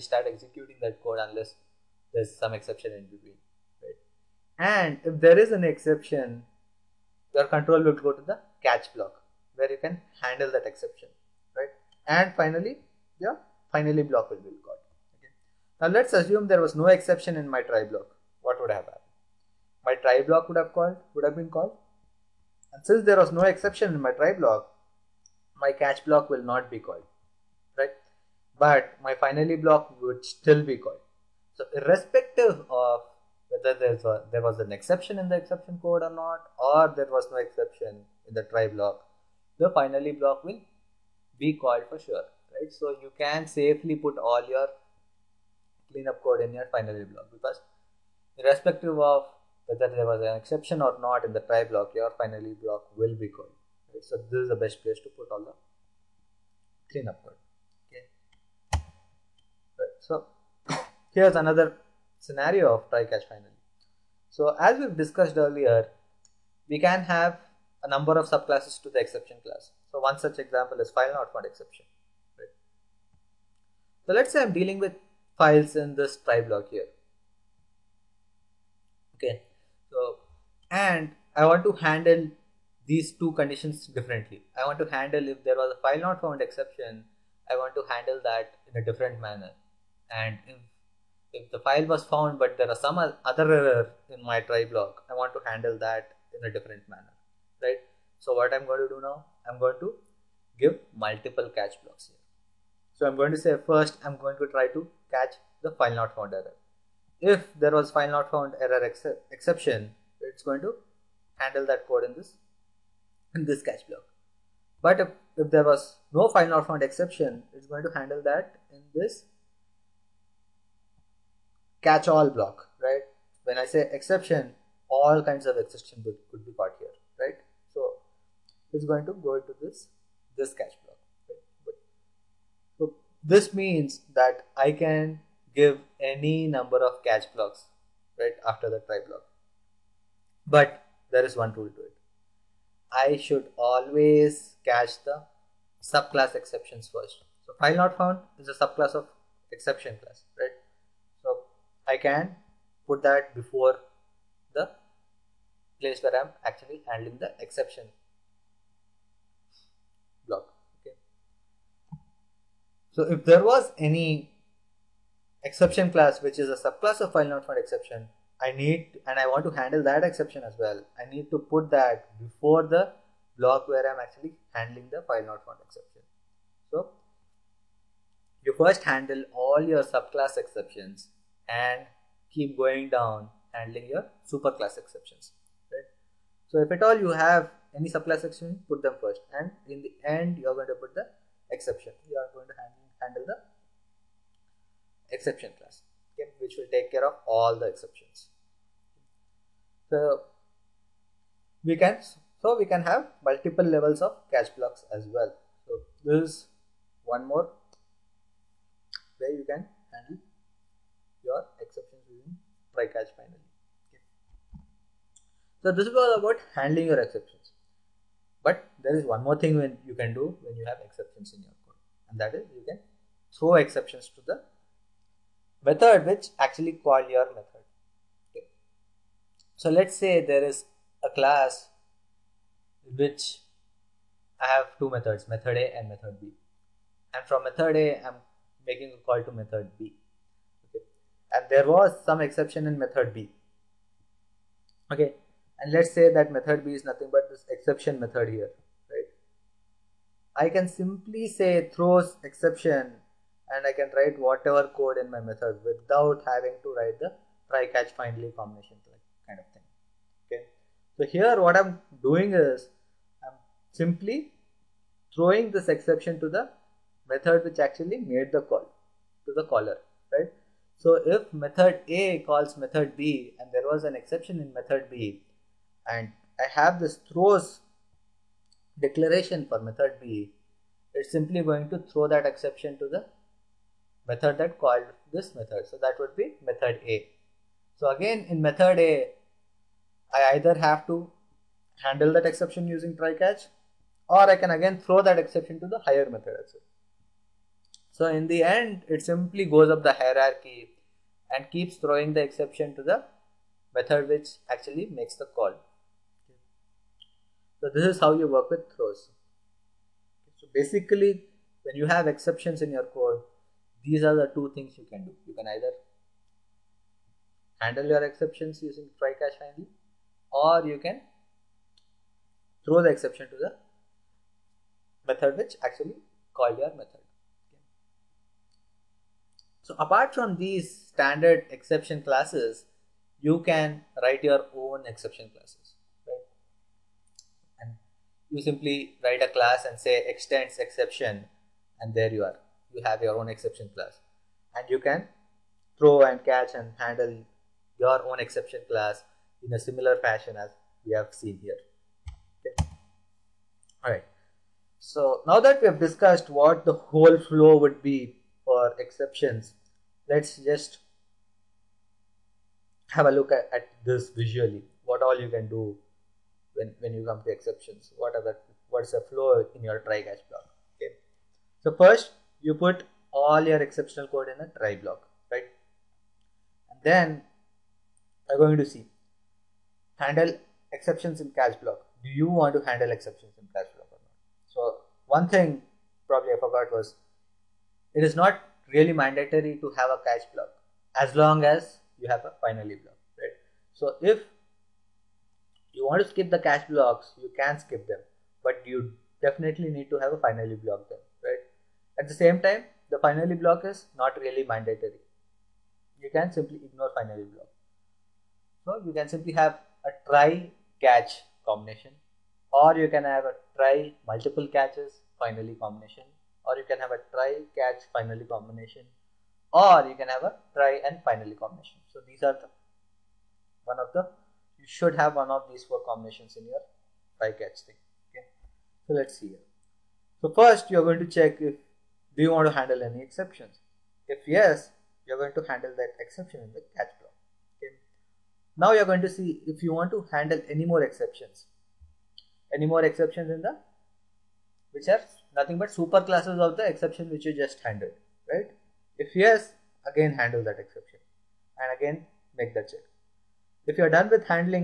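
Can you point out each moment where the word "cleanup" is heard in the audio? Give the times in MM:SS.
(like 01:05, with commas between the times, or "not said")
00:45, 00:56.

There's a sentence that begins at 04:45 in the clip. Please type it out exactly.
So that would be method A.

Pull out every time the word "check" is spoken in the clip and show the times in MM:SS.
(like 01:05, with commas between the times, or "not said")
07:11, 07:32.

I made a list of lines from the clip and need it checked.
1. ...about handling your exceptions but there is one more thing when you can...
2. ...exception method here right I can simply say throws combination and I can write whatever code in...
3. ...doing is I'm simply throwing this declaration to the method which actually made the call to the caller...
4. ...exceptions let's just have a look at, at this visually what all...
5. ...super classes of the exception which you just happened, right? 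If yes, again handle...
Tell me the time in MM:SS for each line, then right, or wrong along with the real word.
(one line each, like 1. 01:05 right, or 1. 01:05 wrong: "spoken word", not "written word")
1. 03:36 right
2. 04:07 wrong: "exception", not "combination"
3. 04:22 wrong: "exception", not "declaration"
4. 05:58 right
5. 07:25 wrong: "handled", not "happened".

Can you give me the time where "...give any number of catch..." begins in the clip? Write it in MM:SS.
02:15.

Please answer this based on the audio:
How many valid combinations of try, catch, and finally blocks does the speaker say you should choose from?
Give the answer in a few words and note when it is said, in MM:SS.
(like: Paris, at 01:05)
4, at 07:05.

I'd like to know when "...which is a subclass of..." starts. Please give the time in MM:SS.
02:46.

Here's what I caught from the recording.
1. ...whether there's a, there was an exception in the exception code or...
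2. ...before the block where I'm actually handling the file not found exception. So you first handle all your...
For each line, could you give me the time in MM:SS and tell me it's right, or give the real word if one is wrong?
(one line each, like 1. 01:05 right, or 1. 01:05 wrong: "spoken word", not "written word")
1. 00:33 right
2. 02:52 right.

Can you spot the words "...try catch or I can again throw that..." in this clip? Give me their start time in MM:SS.
04:52.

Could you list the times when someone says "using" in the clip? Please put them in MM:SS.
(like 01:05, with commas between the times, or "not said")
03:32, 04:52, 05:18.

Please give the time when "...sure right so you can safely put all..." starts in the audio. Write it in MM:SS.
00:41.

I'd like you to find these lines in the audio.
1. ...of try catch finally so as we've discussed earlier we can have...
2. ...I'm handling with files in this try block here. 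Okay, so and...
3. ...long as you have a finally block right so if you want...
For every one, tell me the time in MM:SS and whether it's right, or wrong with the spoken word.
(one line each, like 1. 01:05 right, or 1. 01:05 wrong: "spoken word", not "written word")
1. 01:02 right
2. 01:14 wrong: "dealing", not "handling"
3. 06:31 right.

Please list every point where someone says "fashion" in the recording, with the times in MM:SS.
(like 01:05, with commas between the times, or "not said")
05:49.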